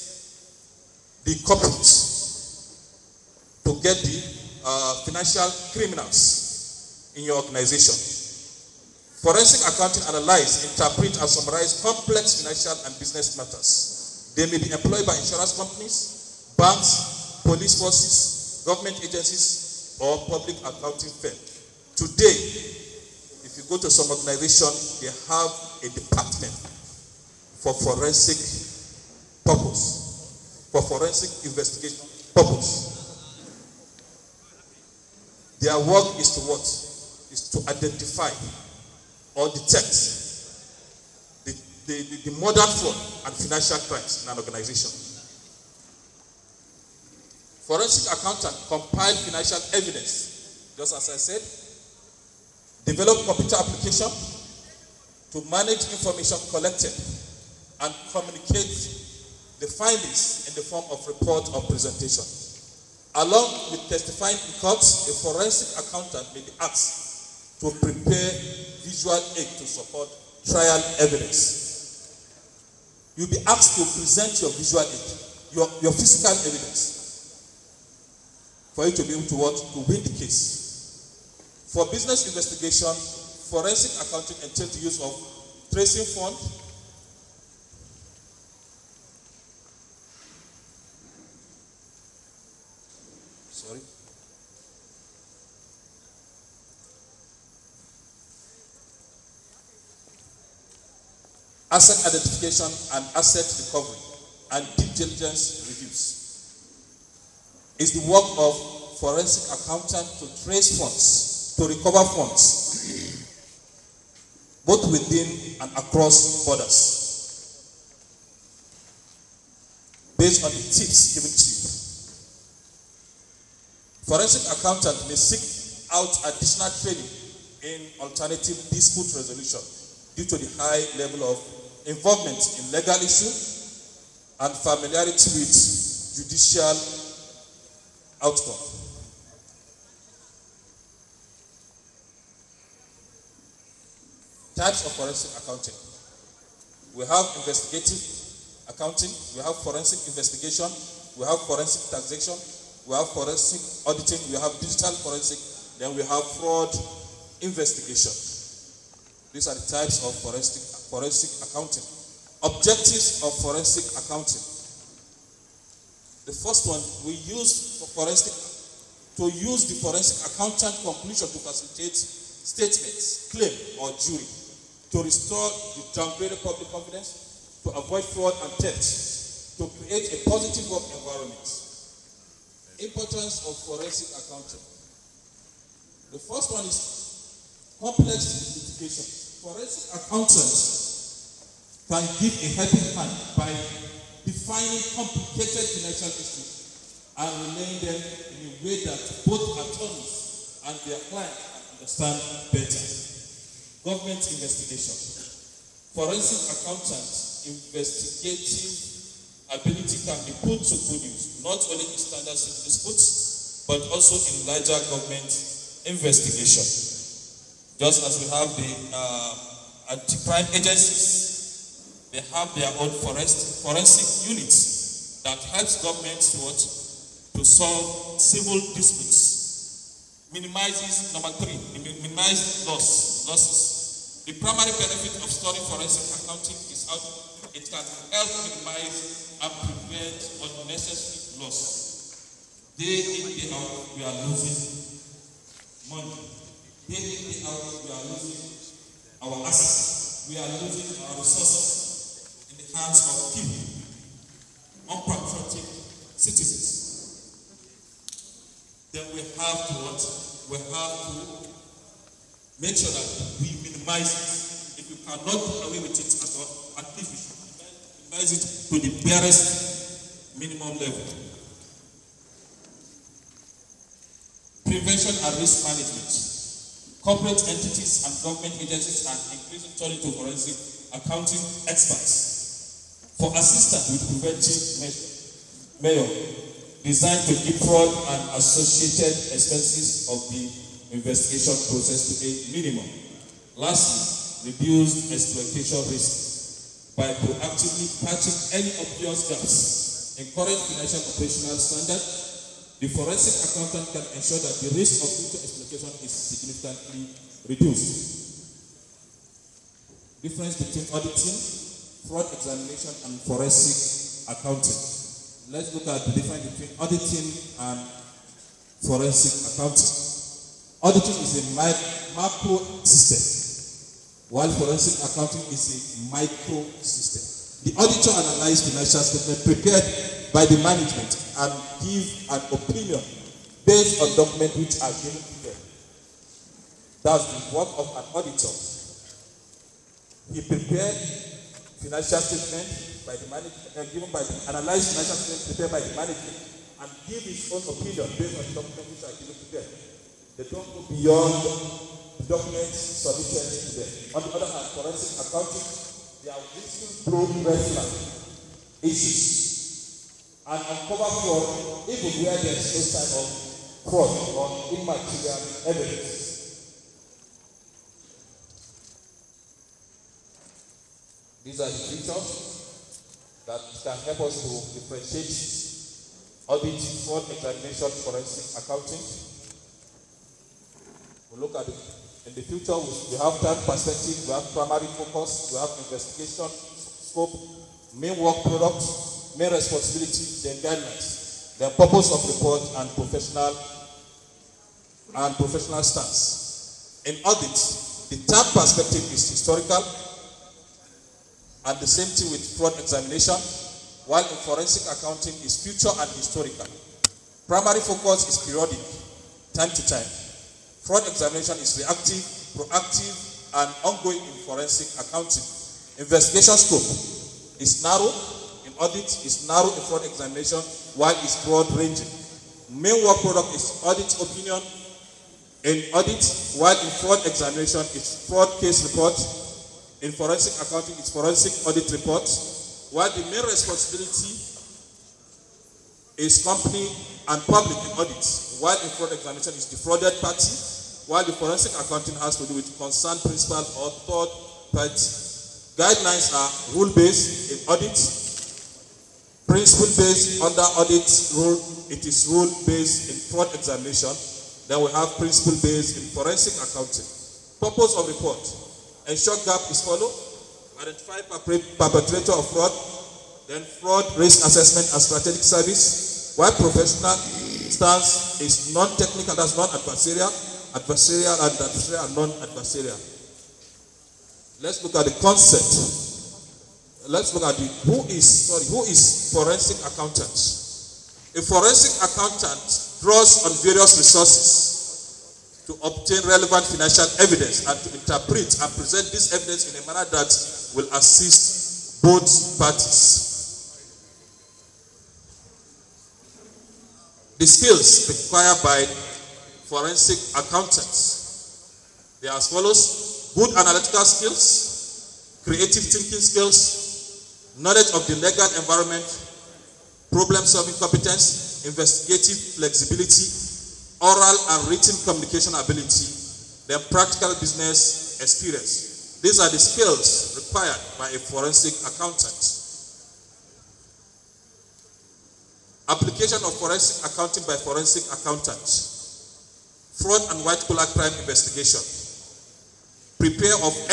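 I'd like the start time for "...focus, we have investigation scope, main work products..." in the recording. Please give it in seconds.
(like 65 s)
384 s.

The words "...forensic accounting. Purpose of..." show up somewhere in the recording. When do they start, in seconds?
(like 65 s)
456 s.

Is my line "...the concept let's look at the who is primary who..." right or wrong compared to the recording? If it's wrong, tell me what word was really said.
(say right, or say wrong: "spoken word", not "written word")
wrong: "sorry", not "primary".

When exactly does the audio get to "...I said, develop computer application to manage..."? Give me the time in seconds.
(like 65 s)
51 s.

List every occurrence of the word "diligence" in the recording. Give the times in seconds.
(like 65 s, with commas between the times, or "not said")
104 s.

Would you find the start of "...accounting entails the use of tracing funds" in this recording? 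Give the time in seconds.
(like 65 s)
83 s.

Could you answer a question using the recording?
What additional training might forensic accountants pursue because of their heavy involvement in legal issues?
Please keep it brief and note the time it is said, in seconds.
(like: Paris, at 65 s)
Alternative dispute resolution, at 128 s.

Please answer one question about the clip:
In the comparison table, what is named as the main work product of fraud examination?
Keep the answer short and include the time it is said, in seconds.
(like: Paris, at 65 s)
Fraud case report, at 428 s.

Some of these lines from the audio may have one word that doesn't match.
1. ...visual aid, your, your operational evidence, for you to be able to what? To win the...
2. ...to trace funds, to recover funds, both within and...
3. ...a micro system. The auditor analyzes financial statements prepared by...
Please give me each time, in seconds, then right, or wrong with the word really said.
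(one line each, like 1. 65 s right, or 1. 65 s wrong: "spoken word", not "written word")
1. 74 s wrong: "physical", not "operational"
2. 110 s right
3. 326 s right.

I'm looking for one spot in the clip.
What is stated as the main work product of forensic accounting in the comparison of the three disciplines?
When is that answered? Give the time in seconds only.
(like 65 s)
431 s.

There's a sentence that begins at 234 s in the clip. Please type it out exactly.
The primary benefit of storing forensic accounting is how it can help minimize and prevent unnecessary loss.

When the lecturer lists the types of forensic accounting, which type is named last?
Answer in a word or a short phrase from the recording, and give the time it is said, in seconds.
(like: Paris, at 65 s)
Fraud investigation, at 156 s.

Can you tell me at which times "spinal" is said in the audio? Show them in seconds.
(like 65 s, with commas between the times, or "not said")
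not said.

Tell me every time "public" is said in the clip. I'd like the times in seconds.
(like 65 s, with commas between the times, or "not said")
20 s, 176 s, 437 s.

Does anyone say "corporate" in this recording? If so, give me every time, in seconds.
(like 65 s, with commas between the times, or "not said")
1 s, 277 s.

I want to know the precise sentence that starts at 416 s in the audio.
Investigation scope is narrow, audit is narrow in fraud examination while it's broad ranging.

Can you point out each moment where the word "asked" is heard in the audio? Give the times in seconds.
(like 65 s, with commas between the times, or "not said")
66 s, 73 s.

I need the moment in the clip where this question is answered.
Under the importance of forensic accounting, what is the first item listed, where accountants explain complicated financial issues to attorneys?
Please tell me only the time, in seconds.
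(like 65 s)
187 s.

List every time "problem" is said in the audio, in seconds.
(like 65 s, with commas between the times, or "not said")
510 s.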